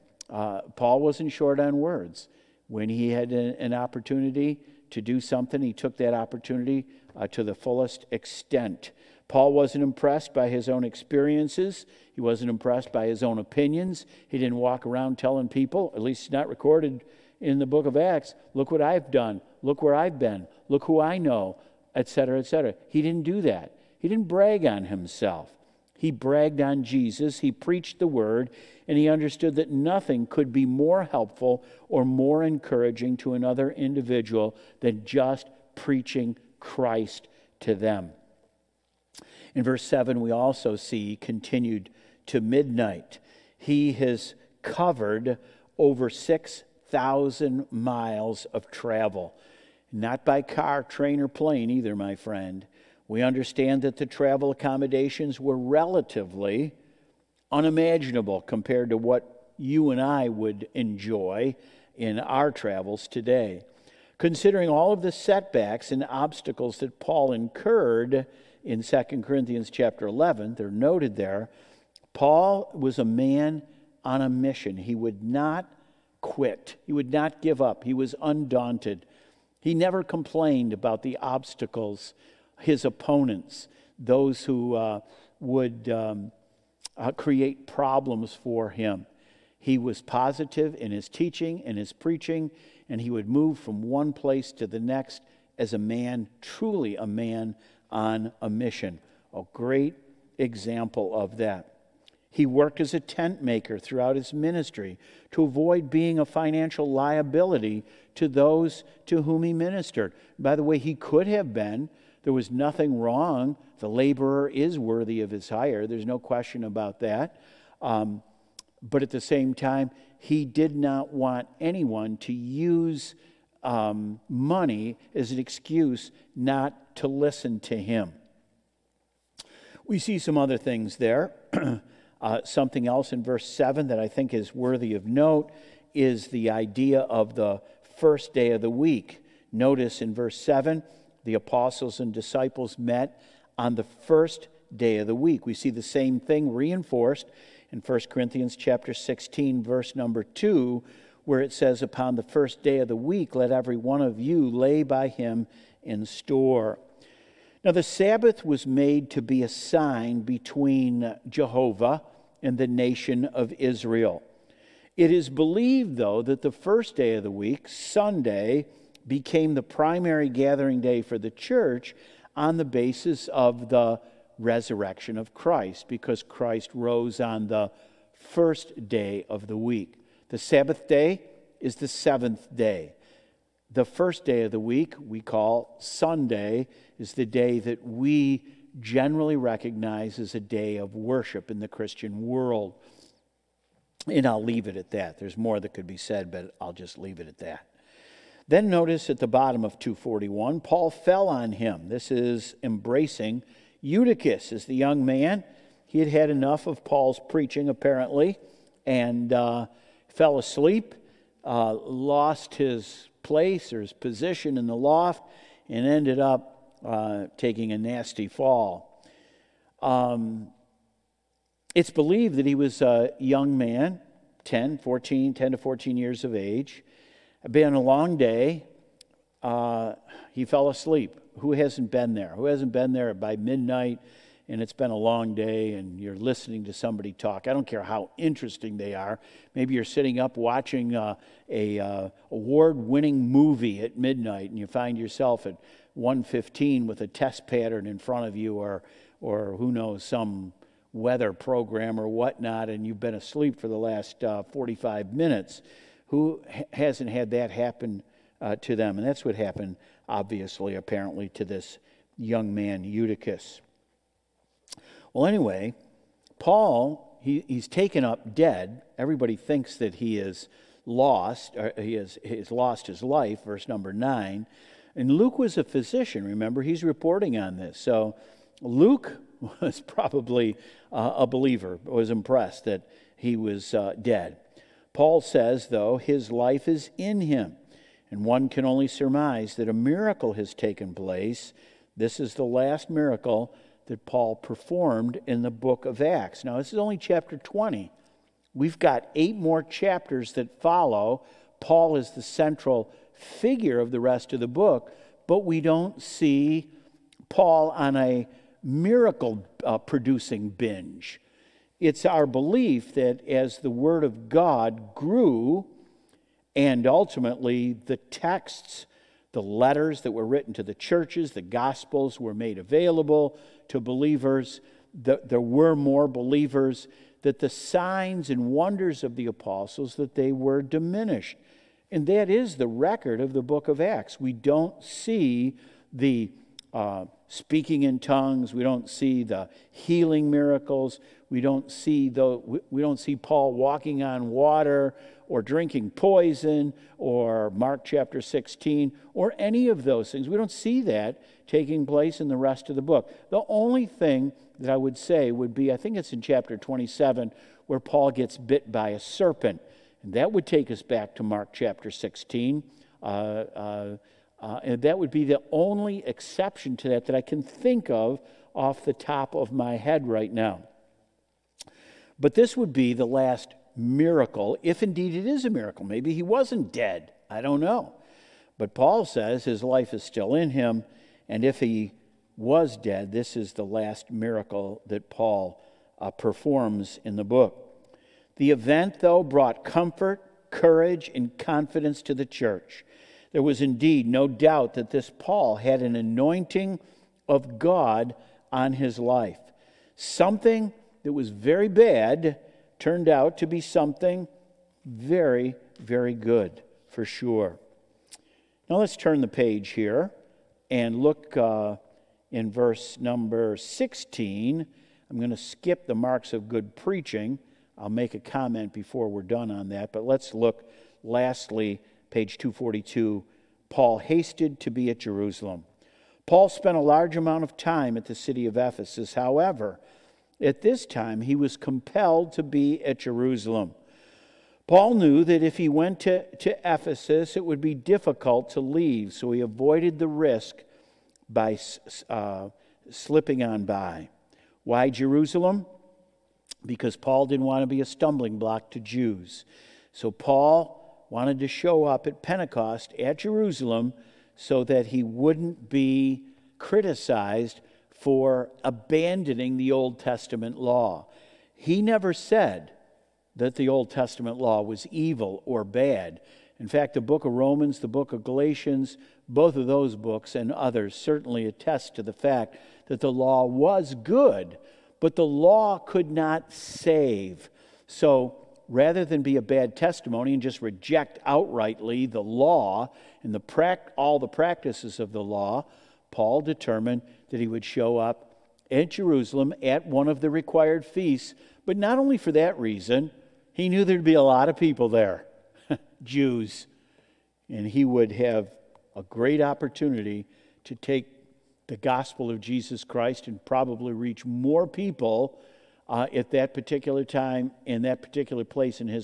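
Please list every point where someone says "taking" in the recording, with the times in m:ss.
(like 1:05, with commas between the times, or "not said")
3:37, 5:51.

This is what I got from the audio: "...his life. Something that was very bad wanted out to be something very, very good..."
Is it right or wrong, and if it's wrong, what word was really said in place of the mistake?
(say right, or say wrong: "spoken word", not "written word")
wrong: "turned", not "wanted".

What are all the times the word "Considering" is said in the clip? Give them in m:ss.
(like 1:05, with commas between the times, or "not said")
1:04.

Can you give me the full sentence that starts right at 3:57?
I don't care how interesting they are.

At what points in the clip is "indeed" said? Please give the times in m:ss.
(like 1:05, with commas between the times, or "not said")
6:14, 6:33.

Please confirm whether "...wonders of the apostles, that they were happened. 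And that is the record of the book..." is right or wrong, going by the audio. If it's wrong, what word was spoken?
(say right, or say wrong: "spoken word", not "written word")
wrong: "diminished", not "happened".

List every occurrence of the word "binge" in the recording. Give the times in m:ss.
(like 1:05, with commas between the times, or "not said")
5:10.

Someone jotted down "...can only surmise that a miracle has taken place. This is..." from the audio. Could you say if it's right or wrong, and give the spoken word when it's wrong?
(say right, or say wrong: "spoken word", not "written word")
right.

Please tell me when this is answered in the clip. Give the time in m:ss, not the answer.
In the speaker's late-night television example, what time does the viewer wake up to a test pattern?
4:05.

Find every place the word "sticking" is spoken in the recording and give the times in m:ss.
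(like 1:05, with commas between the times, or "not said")
not said.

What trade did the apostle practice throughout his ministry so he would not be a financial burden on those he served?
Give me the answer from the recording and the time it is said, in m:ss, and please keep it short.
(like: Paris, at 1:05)
tent maker, at 1:42.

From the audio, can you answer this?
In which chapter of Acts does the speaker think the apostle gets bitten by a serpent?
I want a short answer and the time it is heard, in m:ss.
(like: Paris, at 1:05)
27, at 5:56.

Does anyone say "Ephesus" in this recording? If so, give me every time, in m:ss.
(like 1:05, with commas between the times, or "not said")
7:08, 7:16.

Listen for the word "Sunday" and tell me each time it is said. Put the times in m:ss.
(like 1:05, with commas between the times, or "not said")
2:47, 3:05.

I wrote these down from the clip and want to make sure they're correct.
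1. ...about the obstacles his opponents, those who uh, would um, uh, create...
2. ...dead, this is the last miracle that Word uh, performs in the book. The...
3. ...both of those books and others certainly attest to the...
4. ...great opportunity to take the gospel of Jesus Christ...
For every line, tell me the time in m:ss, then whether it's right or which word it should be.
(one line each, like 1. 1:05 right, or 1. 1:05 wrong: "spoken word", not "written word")
1. 1:20 right
2. 6:22 wrong: "Paul", not "Word"
3. 7:49 right
4. 8:19 right.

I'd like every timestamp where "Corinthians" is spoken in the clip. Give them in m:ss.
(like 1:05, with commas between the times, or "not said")
1:09, 2:28.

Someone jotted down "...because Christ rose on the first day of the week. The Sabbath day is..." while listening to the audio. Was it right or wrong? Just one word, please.
right.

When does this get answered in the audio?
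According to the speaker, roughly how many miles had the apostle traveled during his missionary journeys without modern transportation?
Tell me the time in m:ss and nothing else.
0:46.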